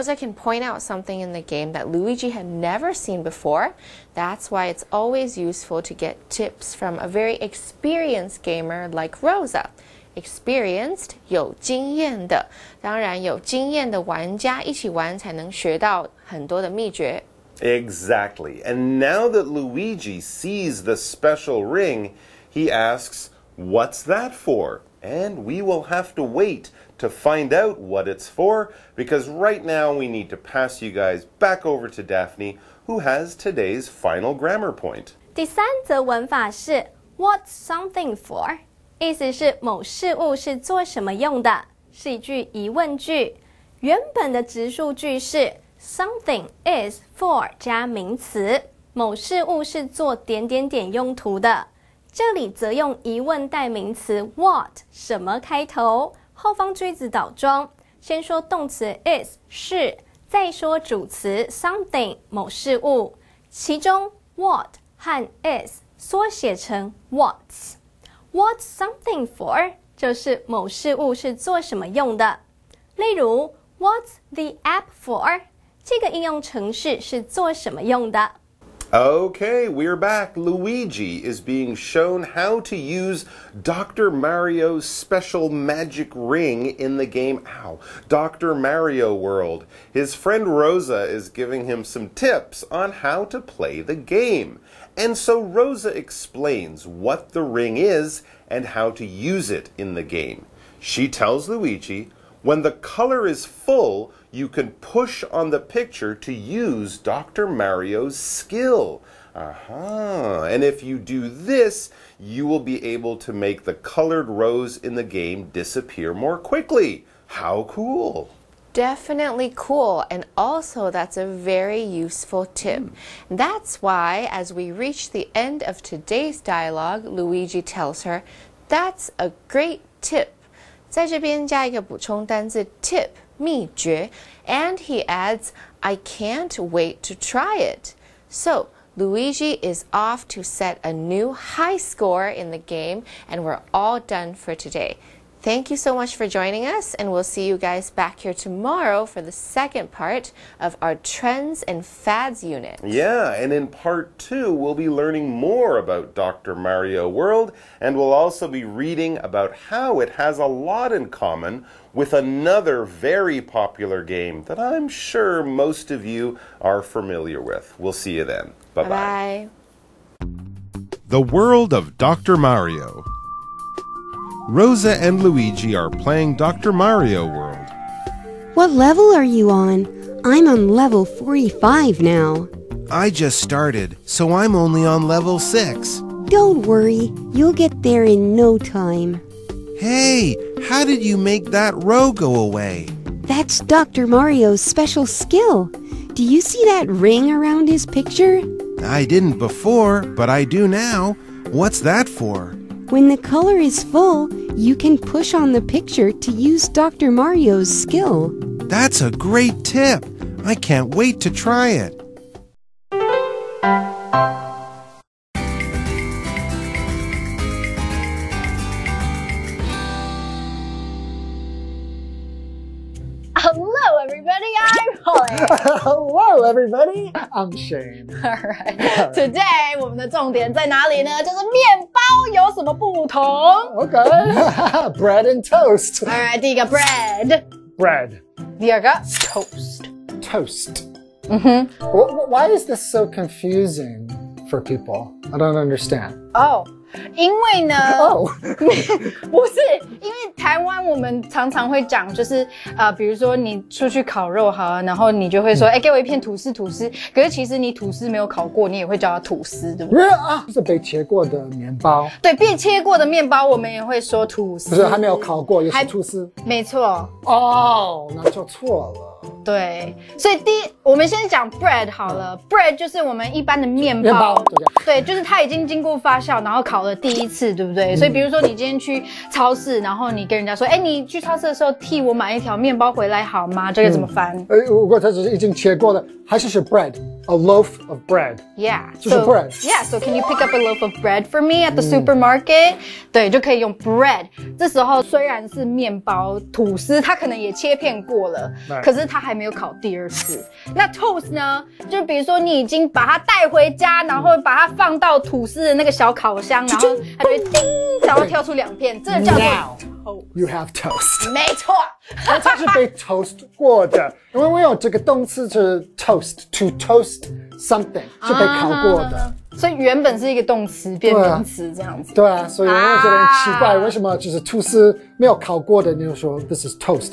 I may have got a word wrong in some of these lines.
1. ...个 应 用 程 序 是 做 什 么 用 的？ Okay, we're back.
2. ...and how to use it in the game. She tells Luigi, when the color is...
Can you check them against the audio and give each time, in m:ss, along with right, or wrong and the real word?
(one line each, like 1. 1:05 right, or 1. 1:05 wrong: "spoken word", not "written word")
1. 1:15 right
2. 1:38 right.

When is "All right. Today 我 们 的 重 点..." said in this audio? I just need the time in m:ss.
3:48.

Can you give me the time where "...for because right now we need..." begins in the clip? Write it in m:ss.
0:28.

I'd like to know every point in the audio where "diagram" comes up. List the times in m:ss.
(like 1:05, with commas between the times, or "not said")
not said.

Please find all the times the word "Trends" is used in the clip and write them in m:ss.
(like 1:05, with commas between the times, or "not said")
2:30.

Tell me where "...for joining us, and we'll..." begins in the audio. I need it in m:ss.
2:26.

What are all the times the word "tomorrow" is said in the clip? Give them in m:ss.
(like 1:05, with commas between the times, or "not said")
2:28.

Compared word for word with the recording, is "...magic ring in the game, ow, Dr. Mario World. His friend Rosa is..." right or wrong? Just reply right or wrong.
right.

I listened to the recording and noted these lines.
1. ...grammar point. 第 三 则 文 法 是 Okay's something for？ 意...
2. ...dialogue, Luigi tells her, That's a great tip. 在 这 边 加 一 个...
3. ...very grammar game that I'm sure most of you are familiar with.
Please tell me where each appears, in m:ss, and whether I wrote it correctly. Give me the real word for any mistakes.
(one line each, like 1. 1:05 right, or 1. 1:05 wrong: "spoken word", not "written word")
1. 0:34 wrong: "What", not "Okay"
2. 2:06 right
3. 2:42 wrong: "popular", not "grammar".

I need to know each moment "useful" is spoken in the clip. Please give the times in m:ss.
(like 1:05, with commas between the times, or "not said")
0:05, 2:01.